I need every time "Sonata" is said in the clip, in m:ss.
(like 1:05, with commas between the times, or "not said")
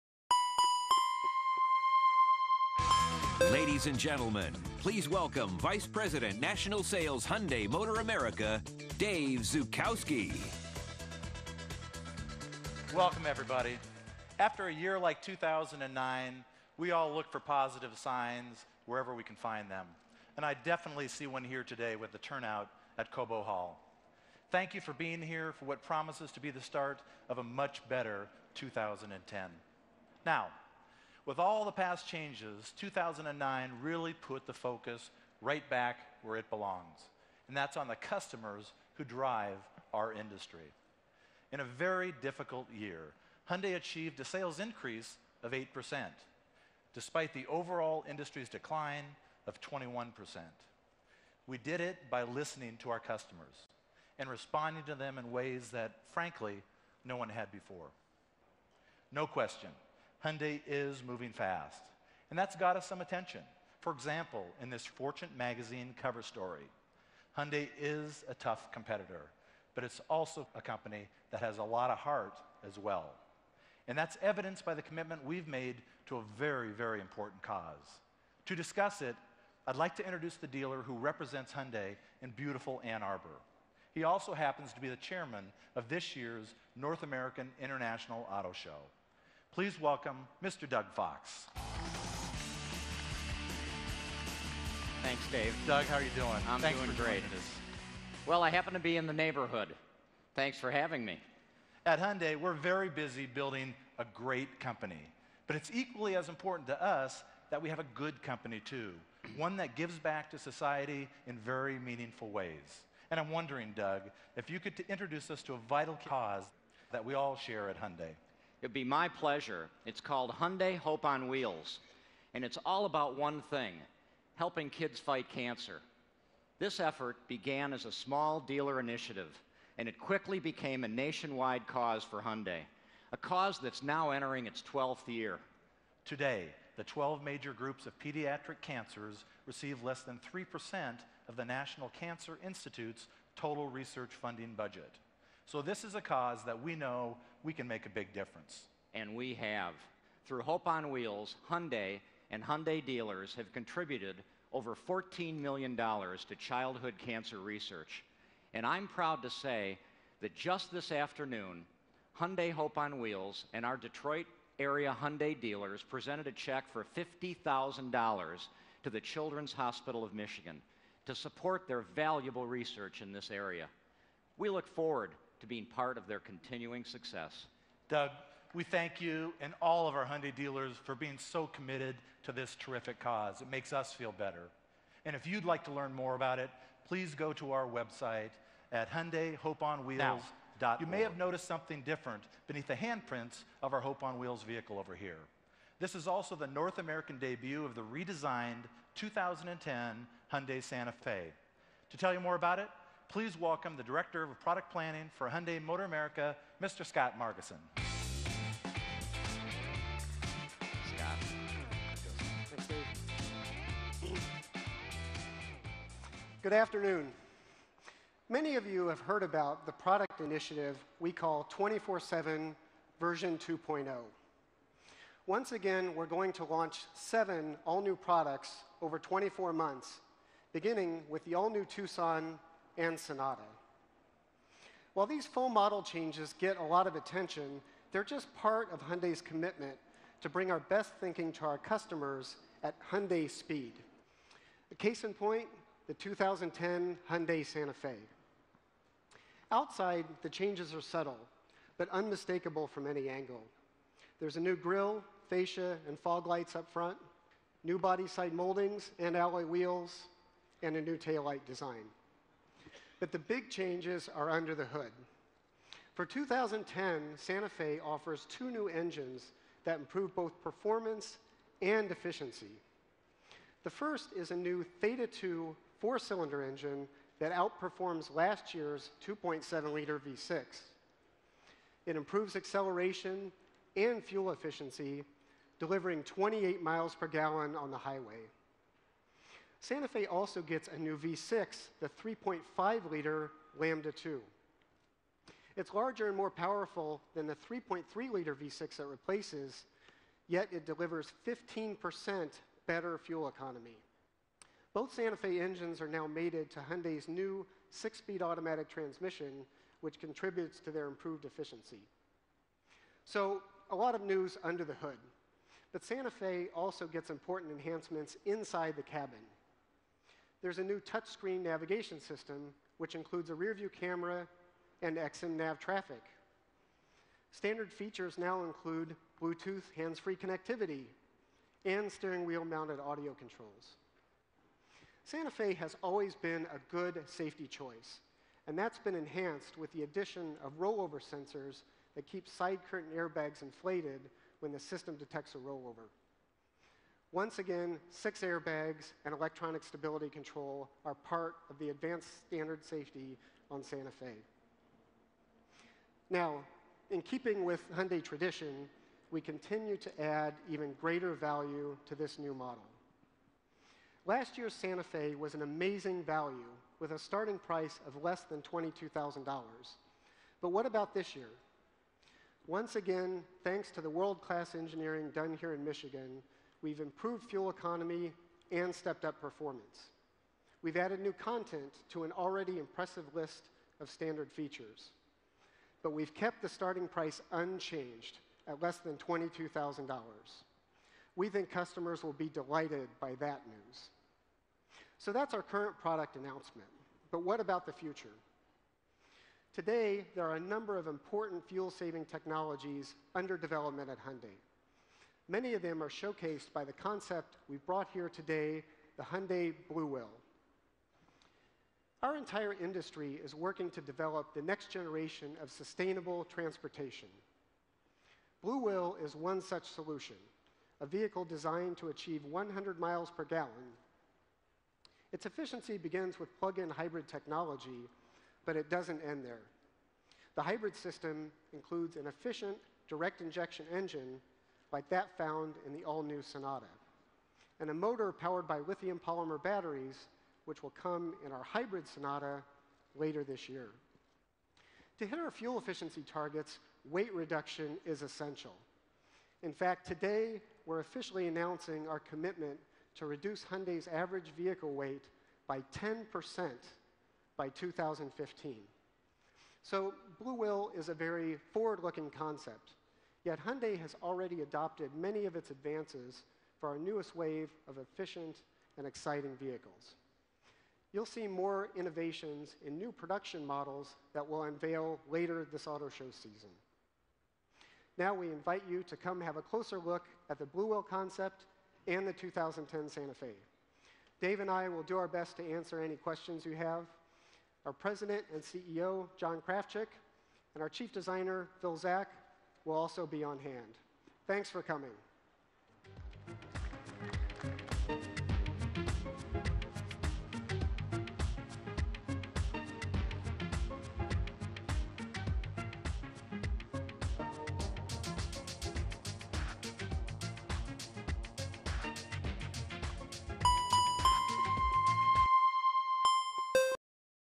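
3:52, 7:16, 7:21.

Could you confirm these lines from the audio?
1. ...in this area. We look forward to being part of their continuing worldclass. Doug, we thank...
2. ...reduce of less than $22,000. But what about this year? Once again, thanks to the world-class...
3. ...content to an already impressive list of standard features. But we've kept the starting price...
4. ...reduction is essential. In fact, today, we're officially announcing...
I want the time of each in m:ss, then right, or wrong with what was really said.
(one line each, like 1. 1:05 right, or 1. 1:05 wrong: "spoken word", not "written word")
1. 2:53 wrong: "success", not "worldclass"
2. 6:07 wrong: "price", not "reduce"
3. 6:21 right
4. 7:27 right.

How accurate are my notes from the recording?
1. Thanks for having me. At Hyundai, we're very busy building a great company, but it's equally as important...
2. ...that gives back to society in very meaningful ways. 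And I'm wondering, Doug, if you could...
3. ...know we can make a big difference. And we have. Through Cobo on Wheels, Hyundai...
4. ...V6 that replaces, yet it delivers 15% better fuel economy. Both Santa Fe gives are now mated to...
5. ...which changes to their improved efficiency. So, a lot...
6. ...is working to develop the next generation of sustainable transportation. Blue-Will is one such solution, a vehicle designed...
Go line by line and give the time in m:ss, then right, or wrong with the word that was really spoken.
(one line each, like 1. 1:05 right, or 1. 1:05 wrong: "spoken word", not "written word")
1. 1:40 right
2. 1:49 right
3. 2:26 wrong: "Hope", not "Cobo"
4. 4:58 wrong: "engines", not "gives"
5. 5:09 wrong: "contributes", not "changes"
6. 6:53 right.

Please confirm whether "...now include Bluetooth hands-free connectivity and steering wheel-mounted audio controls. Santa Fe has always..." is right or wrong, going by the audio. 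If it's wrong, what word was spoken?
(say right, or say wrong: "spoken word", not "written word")
right.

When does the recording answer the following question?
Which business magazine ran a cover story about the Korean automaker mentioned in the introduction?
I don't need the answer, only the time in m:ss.
1:04.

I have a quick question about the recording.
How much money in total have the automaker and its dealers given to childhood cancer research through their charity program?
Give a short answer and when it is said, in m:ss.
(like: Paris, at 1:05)
over $14 million, at 2:34.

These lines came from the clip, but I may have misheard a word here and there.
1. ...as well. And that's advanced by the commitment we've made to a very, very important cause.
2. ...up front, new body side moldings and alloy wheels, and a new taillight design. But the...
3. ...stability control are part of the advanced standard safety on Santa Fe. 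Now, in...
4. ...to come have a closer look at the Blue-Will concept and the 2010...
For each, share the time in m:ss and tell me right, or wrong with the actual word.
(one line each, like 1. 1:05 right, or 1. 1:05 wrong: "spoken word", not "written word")
1. 1:12 wrong: "evidenced", not "advanced"
2. 4:16 right
3. 5:49 right
4. 7:58 right.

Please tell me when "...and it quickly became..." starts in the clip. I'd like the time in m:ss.
2:09.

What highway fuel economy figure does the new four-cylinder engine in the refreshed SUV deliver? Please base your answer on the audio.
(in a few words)
28 miles per gallon.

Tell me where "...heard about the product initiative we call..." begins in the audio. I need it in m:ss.
3:39.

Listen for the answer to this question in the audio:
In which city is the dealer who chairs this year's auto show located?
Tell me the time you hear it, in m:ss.
1:22.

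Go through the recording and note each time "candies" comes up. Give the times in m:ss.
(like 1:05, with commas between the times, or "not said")
not said.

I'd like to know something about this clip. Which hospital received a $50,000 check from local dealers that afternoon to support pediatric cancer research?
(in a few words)
Children's Hospital of Michigan.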